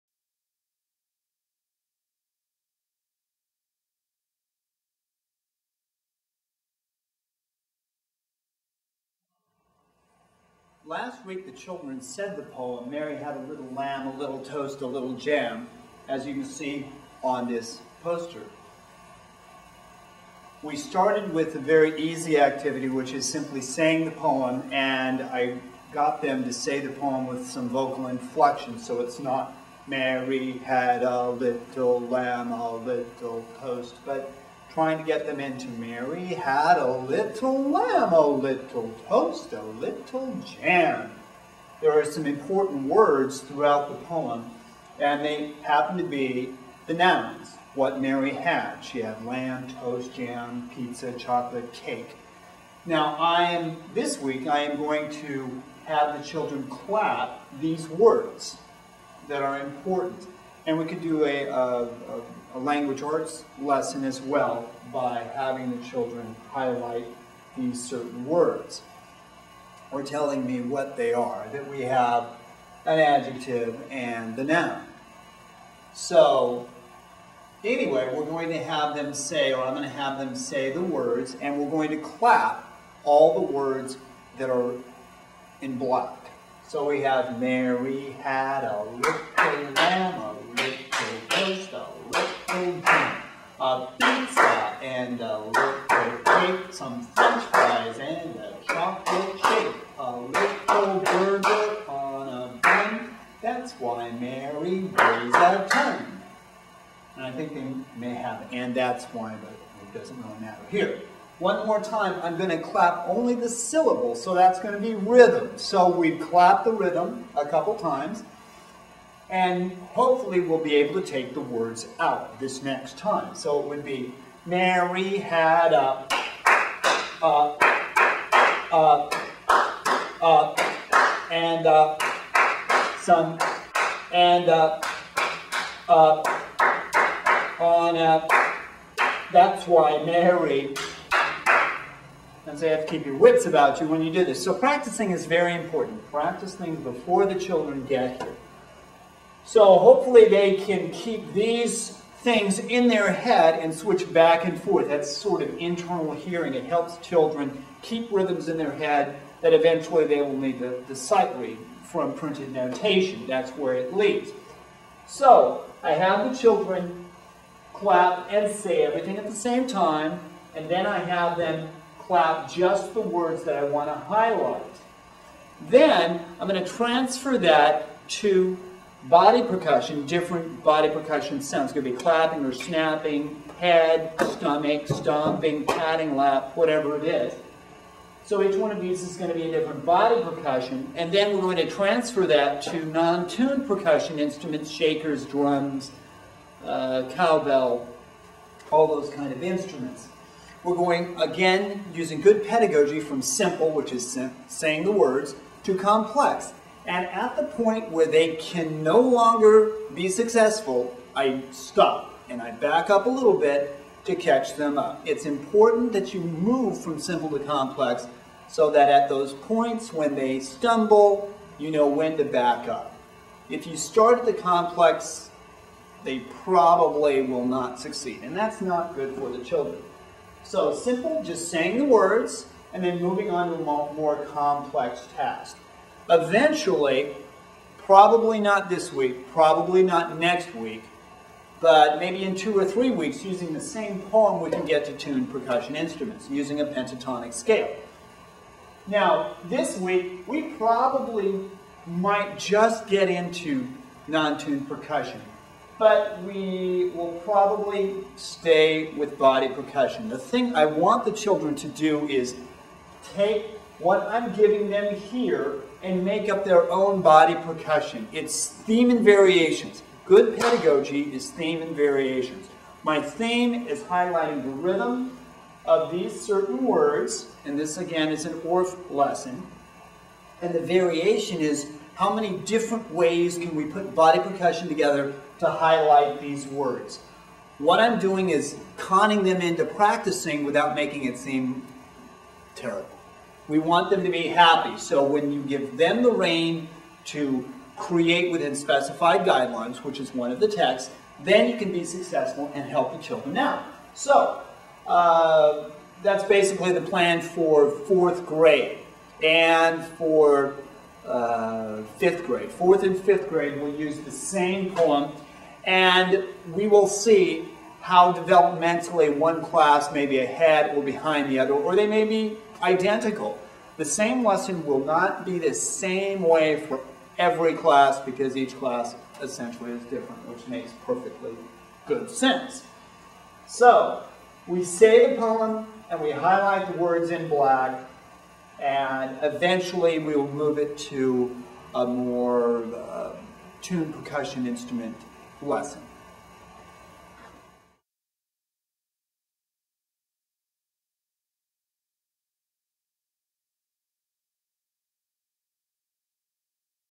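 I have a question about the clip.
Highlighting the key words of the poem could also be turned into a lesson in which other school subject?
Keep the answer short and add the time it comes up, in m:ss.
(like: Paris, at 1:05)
Language arts, at 1:02.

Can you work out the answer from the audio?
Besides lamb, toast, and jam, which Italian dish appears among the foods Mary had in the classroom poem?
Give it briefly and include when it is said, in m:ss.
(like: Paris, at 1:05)
Pizza, at 0:50.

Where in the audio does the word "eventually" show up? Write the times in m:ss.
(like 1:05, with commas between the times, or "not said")
2:39, 3:56, 5:39.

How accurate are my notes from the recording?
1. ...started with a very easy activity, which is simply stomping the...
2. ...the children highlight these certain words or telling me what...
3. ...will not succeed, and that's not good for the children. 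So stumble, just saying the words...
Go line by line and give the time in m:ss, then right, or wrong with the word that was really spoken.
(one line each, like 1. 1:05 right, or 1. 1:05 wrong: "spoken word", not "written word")
1. 0:20 wrong: "saying", not "stomping"
2. 1:05 right
3. 3:47 wrong: "simple", not "stumble".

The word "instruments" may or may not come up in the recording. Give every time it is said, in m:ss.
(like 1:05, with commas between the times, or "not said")
3:14, 3:19, 4:05, 5:44.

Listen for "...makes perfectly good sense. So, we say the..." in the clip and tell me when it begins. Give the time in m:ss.
5:30.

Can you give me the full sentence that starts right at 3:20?
We're going, again, using good pedagogy from simple, which is sim saying the words, to complex.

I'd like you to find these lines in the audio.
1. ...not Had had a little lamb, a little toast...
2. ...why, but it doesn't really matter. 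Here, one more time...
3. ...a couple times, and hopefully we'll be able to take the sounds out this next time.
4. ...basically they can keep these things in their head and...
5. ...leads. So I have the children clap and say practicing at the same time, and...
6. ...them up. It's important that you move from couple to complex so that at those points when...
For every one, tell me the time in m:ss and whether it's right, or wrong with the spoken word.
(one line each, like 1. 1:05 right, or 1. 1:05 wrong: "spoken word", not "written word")
1. 0:29 wrong: "Mary", not "Had"
2. 1:49 right
3. 1:57 wrong: "words", not "sounds"
4. 2:29 wrong: "hopefully", not "basically"
5. 2:43 wrong: "everything", not "practicing"
6. 3:34 wrong: "simple", not "couple".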